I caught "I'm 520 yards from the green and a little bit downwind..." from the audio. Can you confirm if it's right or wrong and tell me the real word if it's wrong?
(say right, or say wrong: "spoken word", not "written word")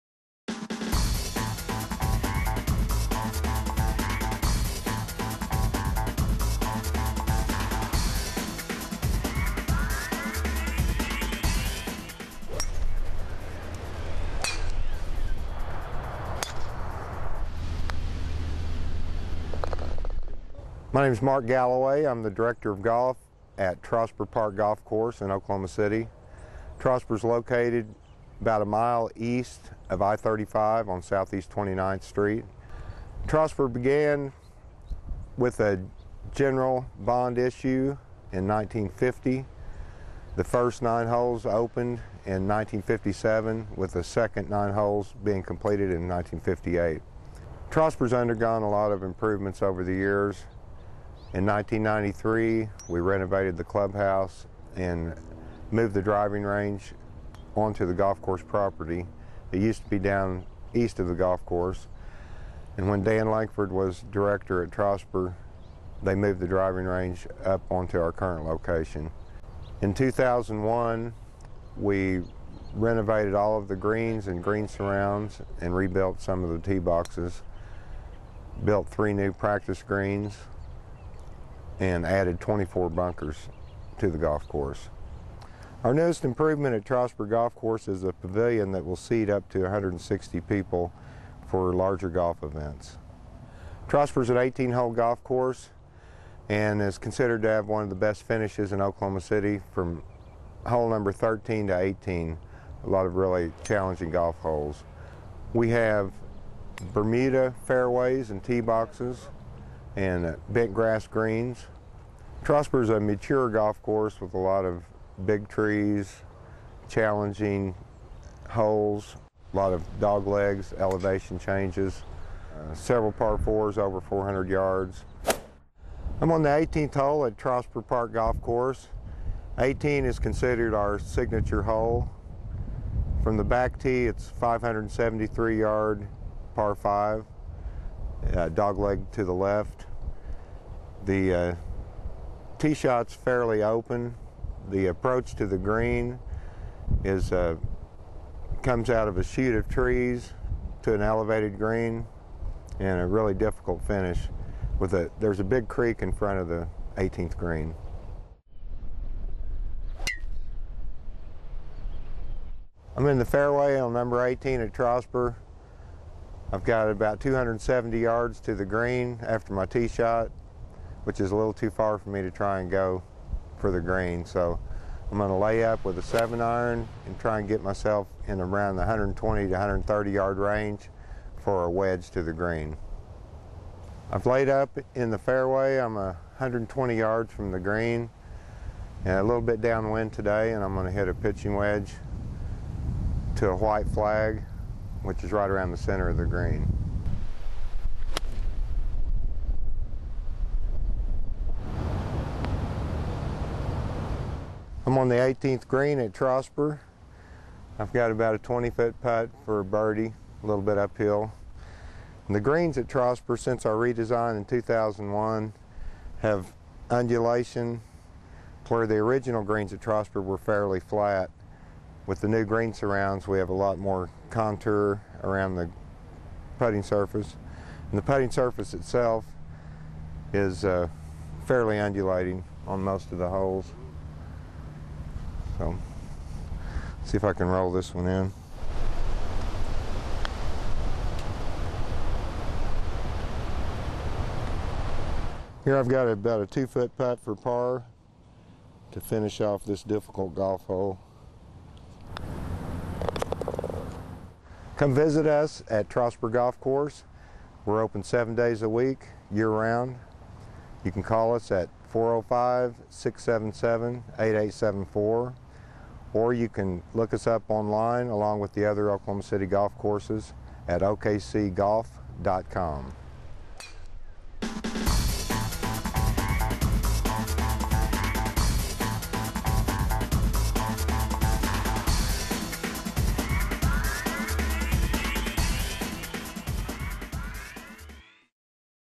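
wrong: "120", not "520".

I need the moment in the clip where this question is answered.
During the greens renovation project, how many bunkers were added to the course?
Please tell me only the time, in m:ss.
1:22.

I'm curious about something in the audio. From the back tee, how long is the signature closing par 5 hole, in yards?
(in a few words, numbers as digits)
573 yards.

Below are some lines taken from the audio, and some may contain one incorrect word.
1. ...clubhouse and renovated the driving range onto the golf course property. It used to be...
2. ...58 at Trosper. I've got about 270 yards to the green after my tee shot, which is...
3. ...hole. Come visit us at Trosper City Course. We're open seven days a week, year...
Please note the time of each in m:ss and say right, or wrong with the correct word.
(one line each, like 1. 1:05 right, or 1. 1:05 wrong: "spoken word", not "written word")
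1. 0:53 wrong: "moved", not "renovated"
2. 2:44 wrong: "18", not "58"
3. 4:10 wrong: "Golf", not "City".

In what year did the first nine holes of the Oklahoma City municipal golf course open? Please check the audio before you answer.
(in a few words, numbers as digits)
1957.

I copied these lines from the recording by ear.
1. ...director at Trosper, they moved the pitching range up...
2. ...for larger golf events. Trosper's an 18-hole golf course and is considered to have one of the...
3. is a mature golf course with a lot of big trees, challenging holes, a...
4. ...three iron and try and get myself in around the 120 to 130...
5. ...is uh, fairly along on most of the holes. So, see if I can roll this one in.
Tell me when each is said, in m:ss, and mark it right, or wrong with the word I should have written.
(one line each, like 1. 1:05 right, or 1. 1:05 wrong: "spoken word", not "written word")
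1. 1:04 wrong: "driving", not "pitching"
2. 1:31 right
3. 1:52 right
4. 2:56 wrong: "seven", not "three"
5. 3:50 wrong: "undulating", not "along".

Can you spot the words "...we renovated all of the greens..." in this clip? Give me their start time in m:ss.
1:11.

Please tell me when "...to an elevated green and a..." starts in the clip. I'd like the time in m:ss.
2:30.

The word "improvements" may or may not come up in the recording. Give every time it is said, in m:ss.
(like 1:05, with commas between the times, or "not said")
0:49, 1:26.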